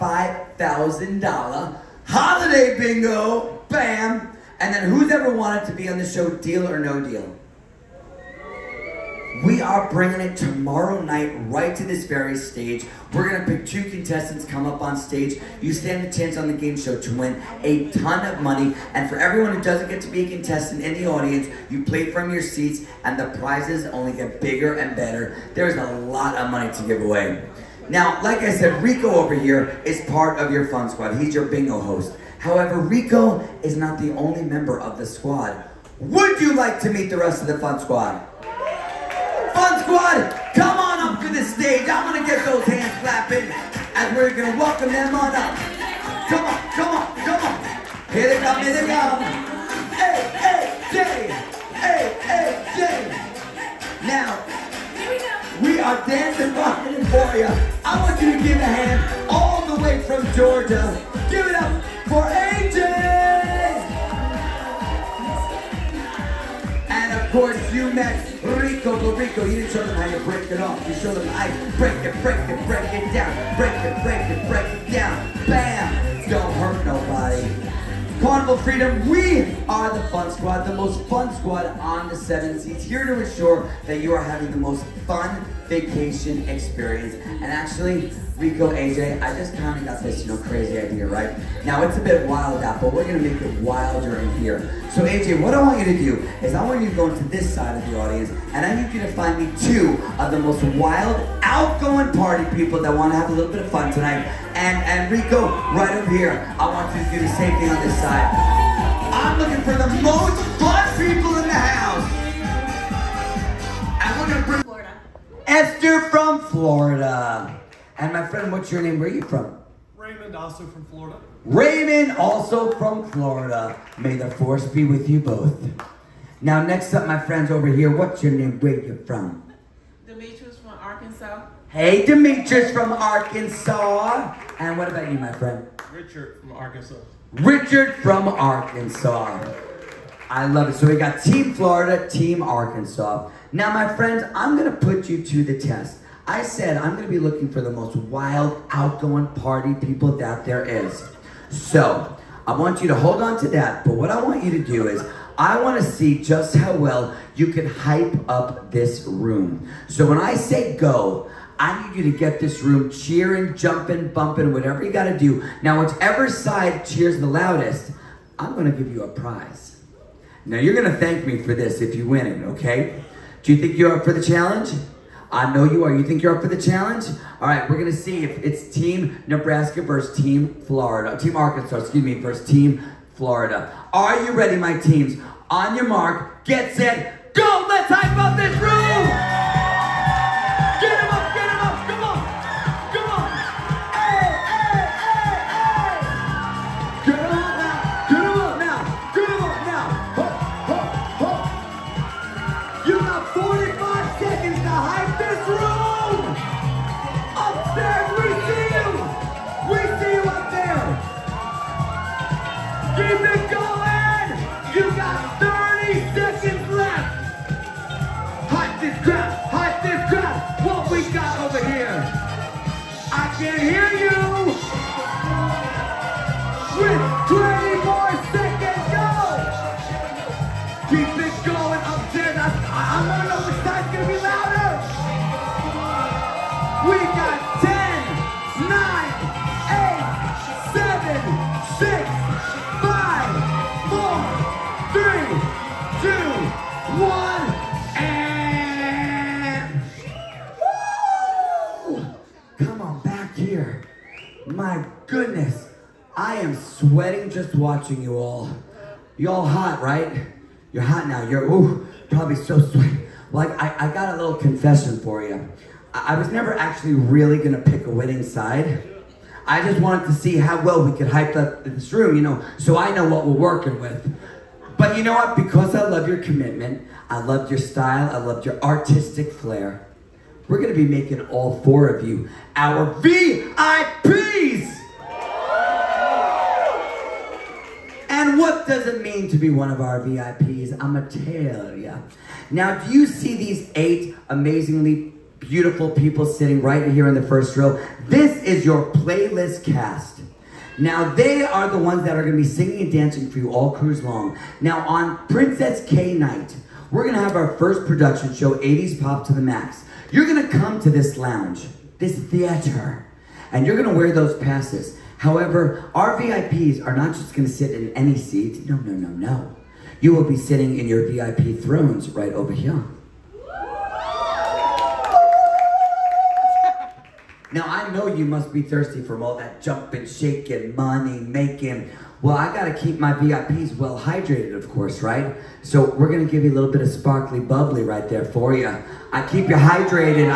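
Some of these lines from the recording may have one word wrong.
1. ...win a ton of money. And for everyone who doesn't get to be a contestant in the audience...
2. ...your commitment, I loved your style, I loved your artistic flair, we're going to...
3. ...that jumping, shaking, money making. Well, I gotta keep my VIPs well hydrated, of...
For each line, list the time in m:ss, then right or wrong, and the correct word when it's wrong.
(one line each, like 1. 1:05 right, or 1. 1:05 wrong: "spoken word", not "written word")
1. 0:17 right
2. 4:36 right
3. 5:29 right.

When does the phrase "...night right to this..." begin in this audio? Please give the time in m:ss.
0:11.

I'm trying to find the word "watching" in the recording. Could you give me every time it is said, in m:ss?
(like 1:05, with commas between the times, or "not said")
4:17.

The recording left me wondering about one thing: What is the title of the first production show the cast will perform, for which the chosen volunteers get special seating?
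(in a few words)
80s Pop to the Max.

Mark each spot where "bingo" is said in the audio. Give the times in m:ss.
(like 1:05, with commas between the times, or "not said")
0:02, 0:31.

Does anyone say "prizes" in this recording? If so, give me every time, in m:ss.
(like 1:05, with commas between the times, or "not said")
0:23, 2:49.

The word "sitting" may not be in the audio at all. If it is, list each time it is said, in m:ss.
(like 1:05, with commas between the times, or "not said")
4:56, 5:20.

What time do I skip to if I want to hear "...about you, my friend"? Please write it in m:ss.
2:14.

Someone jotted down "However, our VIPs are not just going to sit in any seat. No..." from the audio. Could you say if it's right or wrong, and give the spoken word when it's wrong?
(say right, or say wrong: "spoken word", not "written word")
right.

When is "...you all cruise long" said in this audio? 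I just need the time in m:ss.
5:03.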